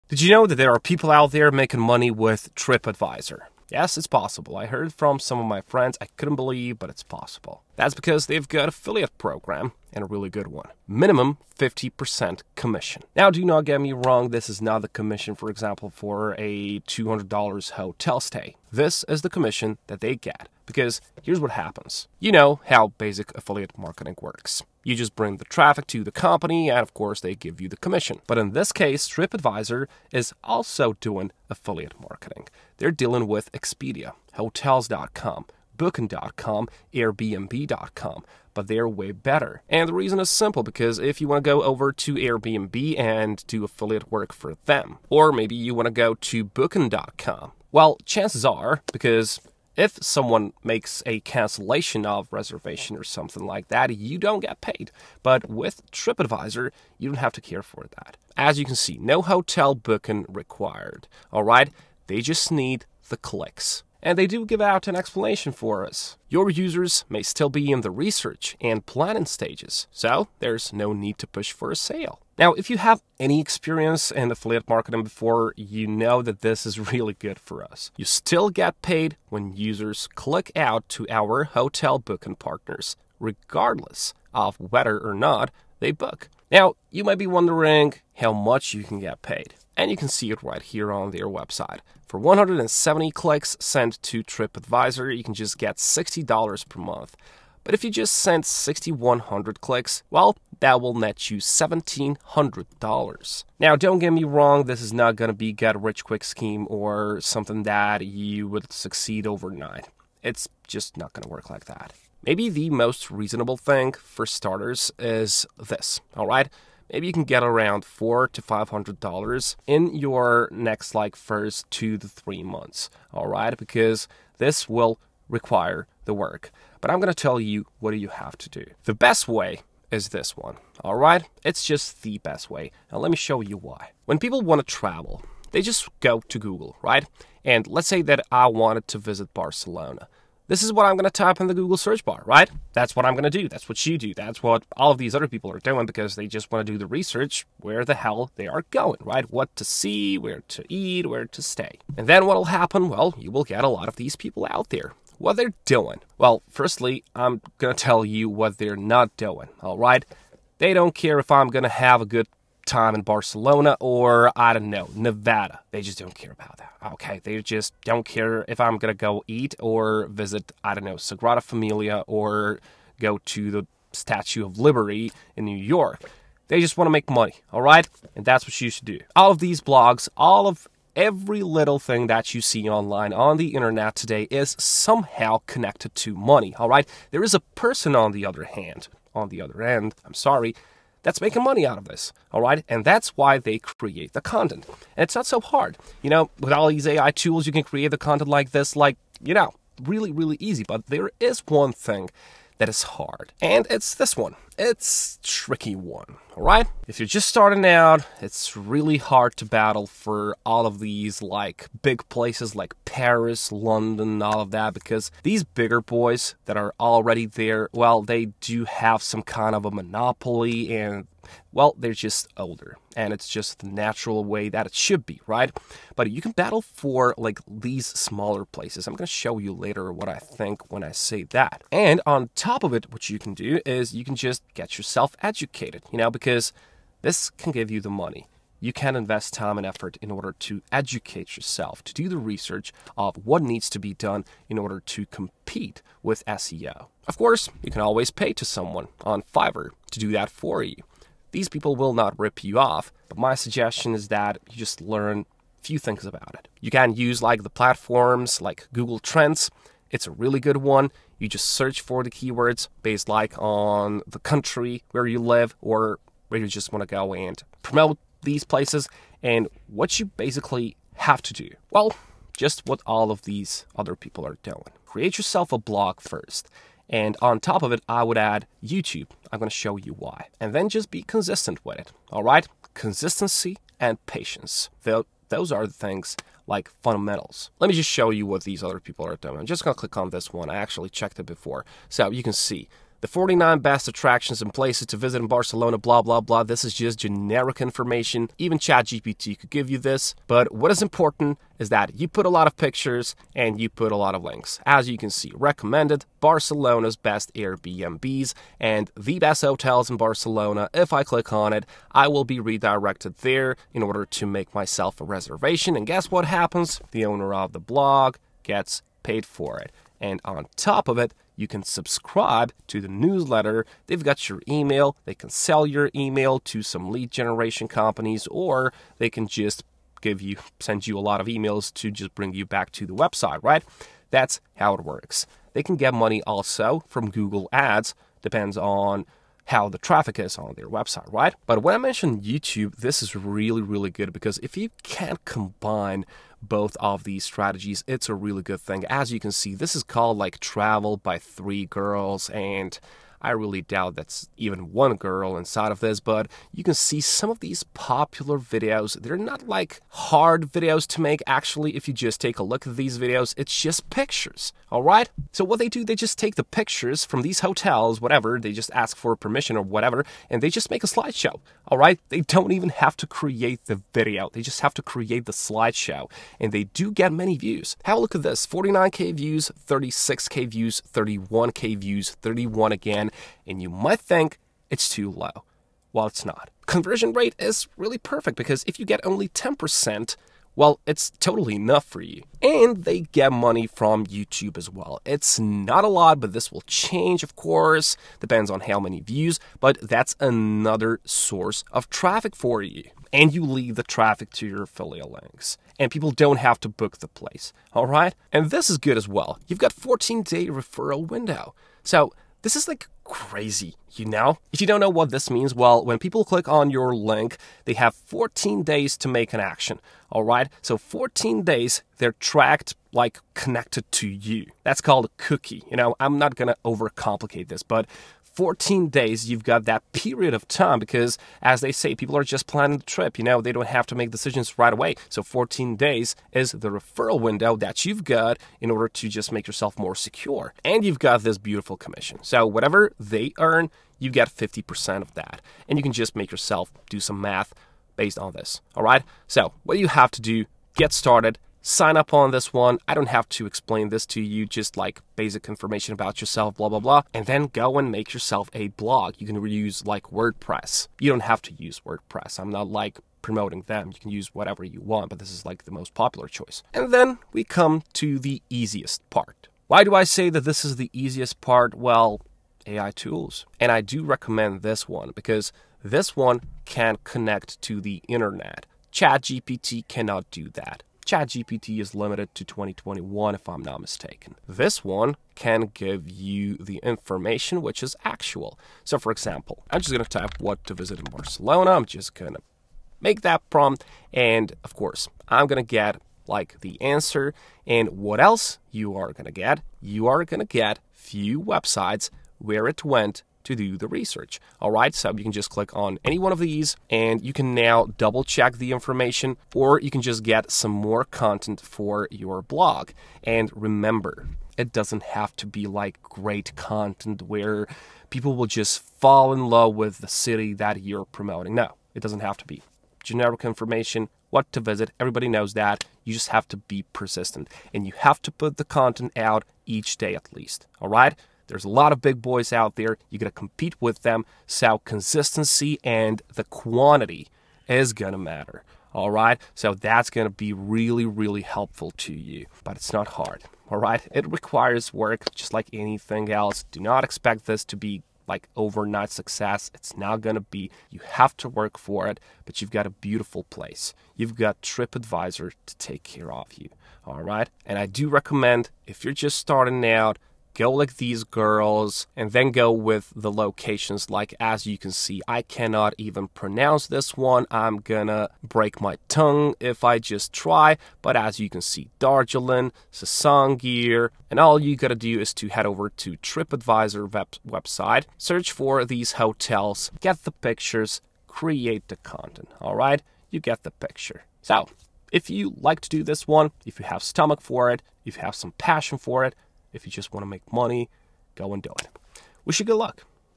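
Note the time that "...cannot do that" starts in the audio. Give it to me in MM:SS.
07:59.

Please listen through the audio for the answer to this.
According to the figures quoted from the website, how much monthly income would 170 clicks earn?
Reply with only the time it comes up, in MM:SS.
01:35.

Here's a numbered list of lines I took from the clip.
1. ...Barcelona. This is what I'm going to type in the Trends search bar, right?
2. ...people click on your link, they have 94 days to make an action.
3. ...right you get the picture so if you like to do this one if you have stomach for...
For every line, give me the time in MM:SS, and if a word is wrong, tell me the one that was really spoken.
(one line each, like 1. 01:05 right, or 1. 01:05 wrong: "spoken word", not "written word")
1. 02:19 wrong: "Google", not "Trends"
2. 06:55 wrong: "14", not "94"
3. 09:42 right.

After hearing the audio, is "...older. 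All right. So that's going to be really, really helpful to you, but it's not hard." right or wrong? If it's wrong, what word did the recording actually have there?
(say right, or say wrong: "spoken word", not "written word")
wrong: "matter", not "older".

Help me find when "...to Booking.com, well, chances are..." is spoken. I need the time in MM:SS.
00:46.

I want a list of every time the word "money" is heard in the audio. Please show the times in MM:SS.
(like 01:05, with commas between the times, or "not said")
00:01, 02:57, 03:06, 03:11, 03:57, 05:35, 06:33, 09:50.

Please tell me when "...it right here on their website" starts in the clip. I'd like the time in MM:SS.
01:30.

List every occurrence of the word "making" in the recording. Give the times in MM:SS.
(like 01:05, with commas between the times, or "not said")
00:01, 03:11.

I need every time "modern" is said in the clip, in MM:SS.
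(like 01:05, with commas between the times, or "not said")
not said.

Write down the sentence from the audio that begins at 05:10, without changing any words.
If I click on it, I will be redirected there in order to make myself a reservation.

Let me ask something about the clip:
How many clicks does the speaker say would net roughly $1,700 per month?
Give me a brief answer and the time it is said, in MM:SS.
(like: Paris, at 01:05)
6,100, at 01:38.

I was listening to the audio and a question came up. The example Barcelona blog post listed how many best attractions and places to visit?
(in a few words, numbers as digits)
49.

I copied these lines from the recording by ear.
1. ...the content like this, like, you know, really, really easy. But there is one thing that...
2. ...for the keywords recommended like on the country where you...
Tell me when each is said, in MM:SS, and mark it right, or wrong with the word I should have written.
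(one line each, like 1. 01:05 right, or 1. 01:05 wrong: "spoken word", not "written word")
1. 03:17 right
2. 04:21 wrong: "based", not "recommended".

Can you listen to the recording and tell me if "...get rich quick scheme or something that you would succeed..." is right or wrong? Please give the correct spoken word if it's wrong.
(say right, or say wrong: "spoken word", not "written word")
right.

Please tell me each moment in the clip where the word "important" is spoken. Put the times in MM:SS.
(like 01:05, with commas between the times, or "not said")
05:00.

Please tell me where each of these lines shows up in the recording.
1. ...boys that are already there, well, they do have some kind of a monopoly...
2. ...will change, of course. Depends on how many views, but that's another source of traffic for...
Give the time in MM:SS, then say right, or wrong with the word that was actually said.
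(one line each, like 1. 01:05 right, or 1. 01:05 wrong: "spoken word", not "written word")
1. 03:35 right
2. 06:36 right.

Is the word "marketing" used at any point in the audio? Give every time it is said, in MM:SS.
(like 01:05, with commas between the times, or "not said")
00:23, 00:32, 01:14.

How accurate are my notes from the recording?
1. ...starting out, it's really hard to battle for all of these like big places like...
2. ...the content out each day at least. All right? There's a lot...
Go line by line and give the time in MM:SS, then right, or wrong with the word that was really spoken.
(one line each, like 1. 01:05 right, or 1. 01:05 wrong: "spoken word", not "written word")
1. 03:27 right
2. 08:48 right.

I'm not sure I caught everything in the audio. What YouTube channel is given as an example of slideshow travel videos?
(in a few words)
Travel by Three Girls.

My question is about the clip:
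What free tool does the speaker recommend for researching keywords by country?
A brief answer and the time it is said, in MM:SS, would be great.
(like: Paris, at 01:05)
Google Trends, at 04:18.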